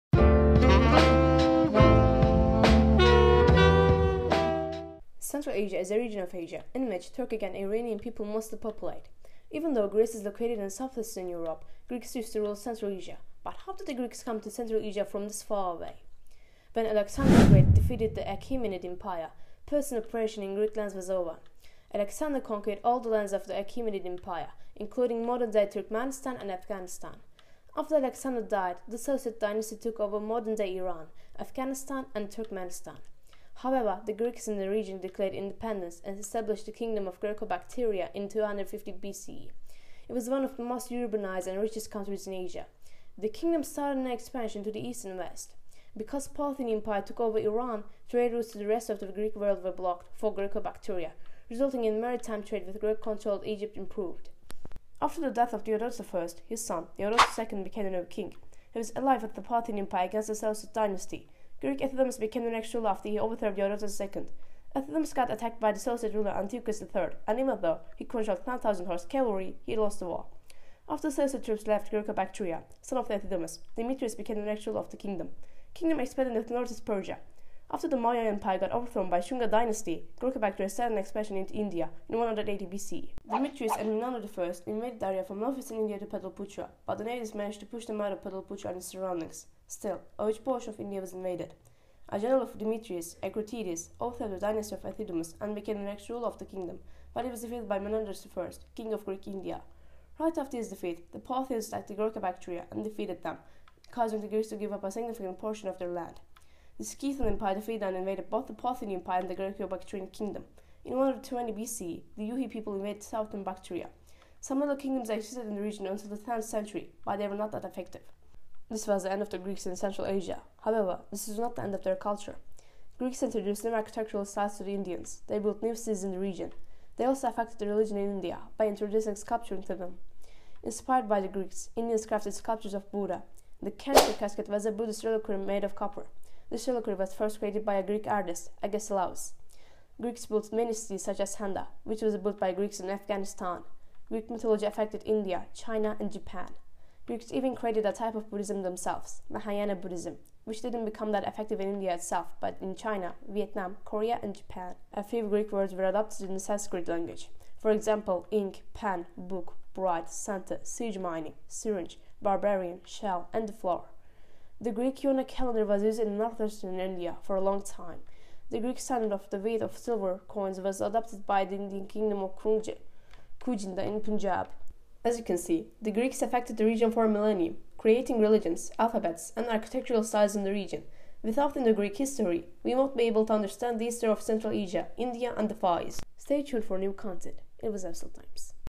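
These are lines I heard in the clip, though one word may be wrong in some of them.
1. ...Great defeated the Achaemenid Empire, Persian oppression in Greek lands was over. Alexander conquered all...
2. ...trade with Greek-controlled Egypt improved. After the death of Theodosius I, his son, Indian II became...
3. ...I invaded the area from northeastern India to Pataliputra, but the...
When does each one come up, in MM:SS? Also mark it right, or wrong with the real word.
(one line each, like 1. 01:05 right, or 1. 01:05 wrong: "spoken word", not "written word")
1. 00:17 right
2. 00:52 wrong: "Theodosius", not "Indian"
3. 01:24 right.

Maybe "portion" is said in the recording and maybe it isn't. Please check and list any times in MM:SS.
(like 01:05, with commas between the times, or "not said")
01:30, 01:45.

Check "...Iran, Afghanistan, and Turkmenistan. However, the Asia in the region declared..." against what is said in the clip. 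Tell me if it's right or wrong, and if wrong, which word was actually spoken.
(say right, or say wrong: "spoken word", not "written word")
wrong: "Greeks", not "Asia".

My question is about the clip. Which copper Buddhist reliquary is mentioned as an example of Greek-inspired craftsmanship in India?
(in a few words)
Kanishka casket.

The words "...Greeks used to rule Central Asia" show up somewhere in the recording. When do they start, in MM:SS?
00:11.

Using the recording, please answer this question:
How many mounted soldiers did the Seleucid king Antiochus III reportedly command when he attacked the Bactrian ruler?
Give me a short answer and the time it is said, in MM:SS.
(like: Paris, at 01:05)
9,000, at 01:08.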